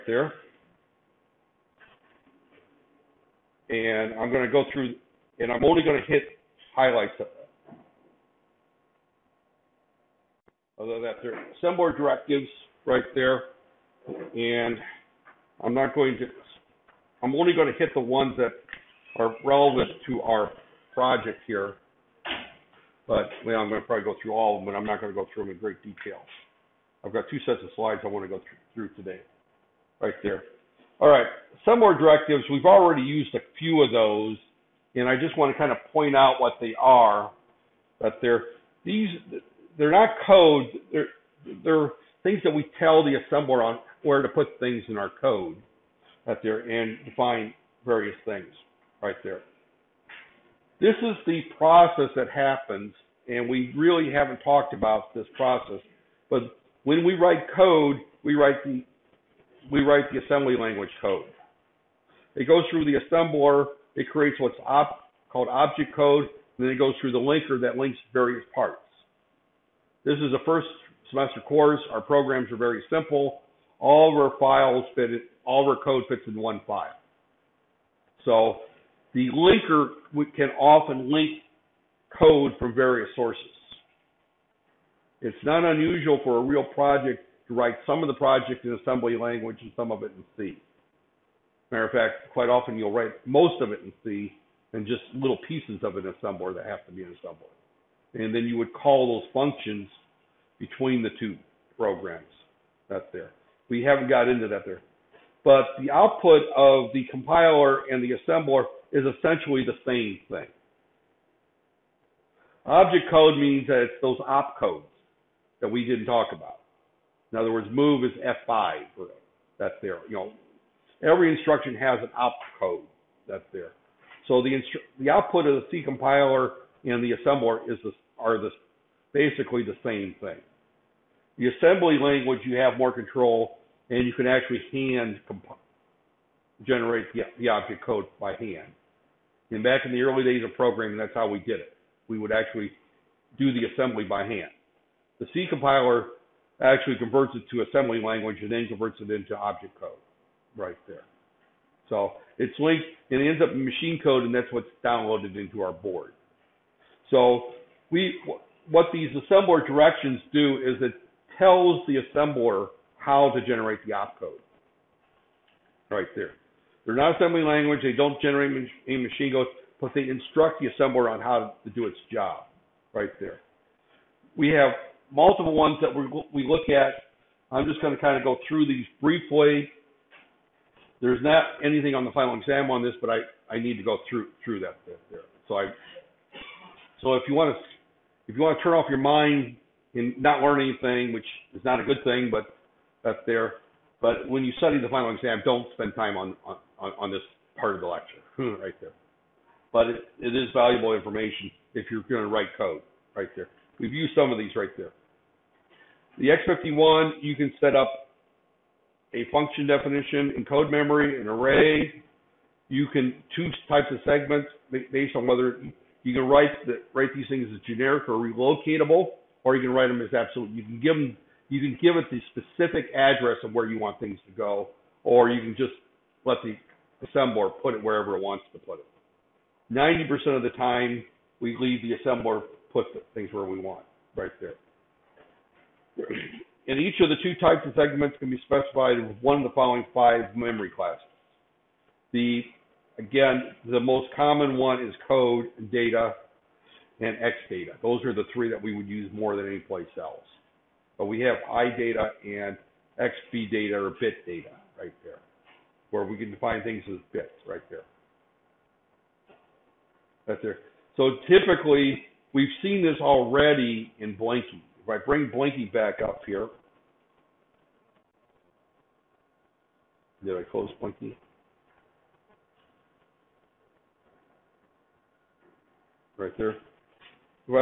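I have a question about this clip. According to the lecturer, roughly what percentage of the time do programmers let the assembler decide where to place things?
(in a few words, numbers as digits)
90%.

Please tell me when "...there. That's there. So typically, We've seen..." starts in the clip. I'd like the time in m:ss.
4:17.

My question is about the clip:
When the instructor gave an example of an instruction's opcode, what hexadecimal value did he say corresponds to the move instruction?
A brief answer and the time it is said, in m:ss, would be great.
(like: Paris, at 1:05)
F5, at 1:58.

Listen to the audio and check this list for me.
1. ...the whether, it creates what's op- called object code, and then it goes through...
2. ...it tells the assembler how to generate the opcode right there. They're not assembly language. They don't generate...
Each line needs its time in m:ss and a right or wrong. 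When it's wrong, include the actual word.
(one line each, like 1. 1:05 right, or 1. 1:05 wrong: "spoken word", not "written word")
1. 1:02 wrong: "assembler", not "whether"
2. 2:40 right.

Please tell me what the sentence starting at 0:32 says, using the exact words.
We've already used a few of those, and I just want to kind of point out what they are.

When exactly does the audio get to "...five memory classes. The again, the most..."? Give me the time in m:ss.
3:59.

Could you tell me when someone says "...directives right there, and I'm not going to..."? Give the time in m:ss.
0:11.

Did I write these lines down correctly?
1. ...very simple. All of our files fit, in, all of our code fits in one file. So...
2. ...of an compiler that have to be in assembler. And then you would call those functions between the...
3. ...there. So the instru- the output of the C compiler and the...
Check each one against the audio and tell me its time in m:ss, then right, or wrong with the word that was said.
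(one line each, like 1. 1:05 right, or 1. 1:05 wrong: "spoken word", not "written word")
1. 1:12 right
2. 1:35 wrong: "assembler", not "compiler"
3. 2:03 right.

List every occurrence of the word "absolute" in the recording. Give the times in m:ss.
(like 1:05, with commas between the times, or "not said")
3:40.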